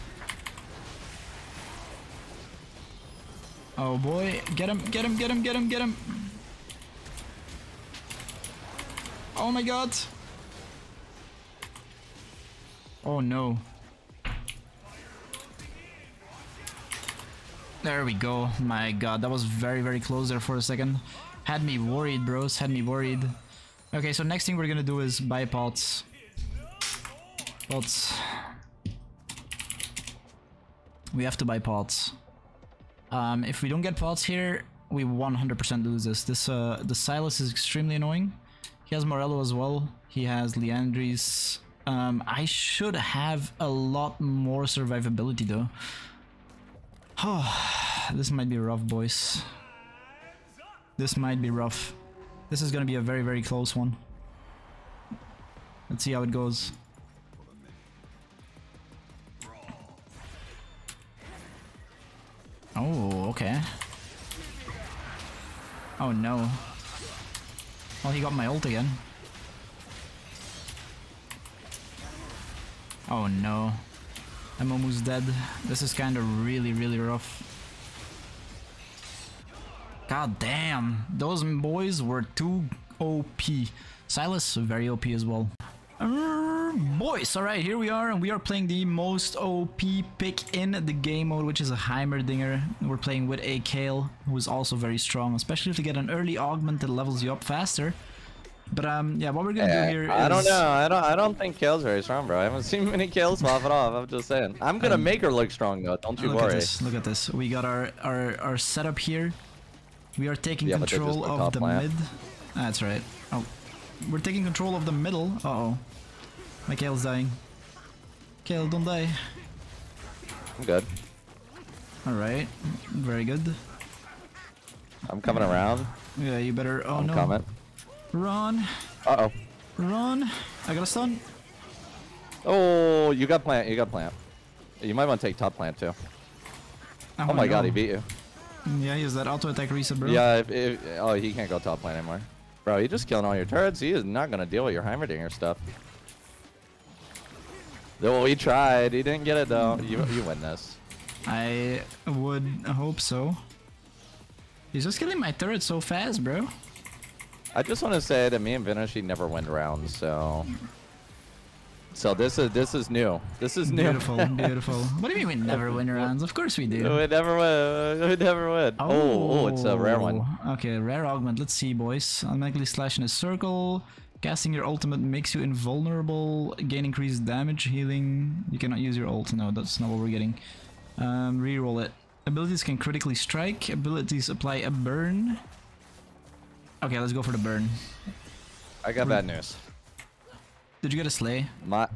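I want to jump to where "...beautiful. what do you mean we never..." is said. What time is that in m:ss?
2:44.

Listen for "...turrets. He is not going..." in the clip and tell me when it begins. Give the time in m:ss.
2:23.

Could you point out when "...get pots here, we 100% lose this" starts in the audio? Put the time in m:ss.
0:33.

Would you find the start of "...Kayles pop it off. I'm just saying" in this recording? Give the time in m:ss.
1:43.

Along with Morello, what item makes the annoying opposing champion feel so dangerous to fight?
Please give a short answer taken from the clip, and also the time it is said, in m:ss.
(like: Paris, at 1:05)
Liandry's, at 0:40.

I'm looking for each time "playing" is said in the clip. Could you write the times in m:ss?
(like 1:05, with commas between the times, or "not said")
1:28, 1:32.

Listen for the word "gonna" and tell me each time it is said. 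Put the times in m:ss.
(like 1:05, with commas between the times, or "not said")
0:24, 0:52, 1:39, 1:44.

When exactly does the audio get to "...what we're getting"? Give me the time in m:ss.
2:59.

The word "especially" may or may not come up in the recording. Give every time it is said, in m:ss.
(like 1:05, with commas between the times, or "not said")
1:35.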